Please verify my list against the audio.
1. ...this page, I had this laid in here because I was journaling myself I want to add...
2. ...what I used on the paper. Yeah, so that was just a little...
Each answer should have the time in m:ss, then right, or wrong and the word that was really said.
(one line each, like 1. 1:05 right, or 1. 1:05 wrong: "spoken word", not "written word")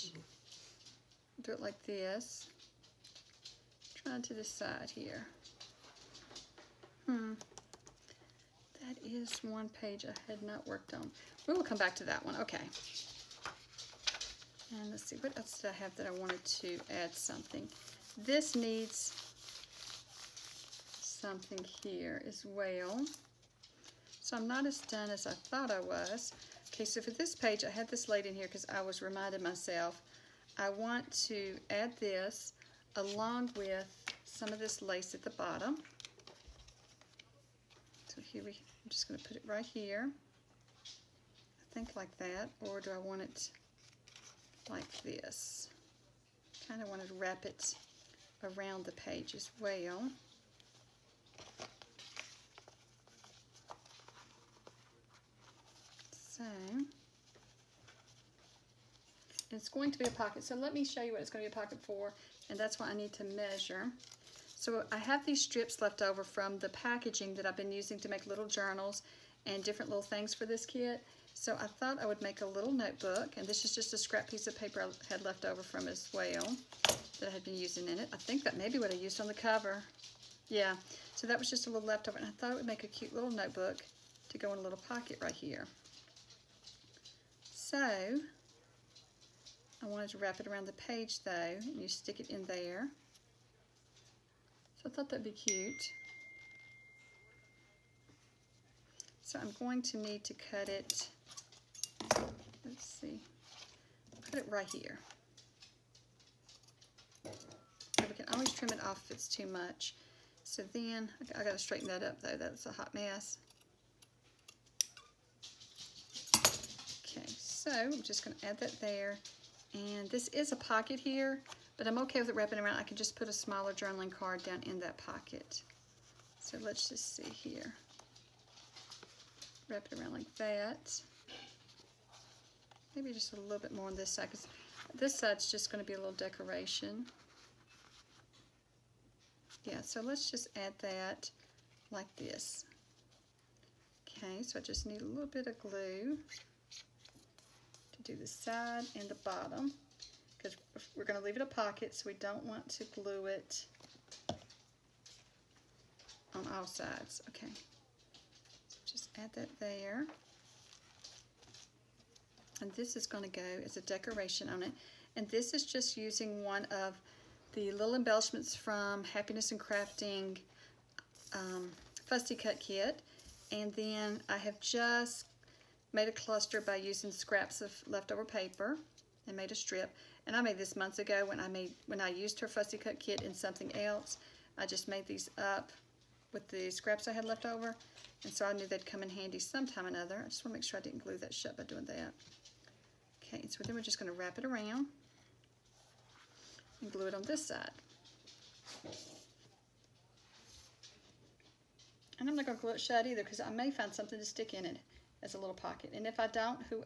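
1. 0:27 wrong: "reminding", not "journaling"
2. 1:18 wrong: "cover", not "paper".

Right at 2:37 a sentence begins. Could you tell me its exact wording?
Okay, so just add that there and this is going to go as a decoration on it.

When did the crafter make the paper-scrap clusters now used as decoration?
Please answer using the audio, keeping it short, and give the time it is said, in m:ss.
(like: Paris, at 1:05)
Months ago, at 3:00.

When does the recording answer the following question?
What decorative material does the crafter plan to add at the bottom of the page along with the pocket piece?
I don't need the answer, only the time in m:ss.
0:34.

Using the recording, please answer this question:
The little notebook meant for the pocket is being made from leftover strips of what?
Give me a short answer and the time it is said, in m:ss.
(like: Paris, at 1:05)
Packaging, at 1:06.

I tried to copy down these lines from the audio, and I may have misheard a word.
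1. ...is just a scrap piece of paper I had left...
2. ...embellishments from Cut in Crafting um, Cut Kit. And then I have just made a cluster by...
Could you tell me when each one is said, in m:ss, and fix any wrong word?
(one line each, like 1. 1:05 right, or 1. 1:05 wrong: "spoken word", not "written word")
1. 1:13 right
2. 2:47 wrong: "Happiness", not "Cut".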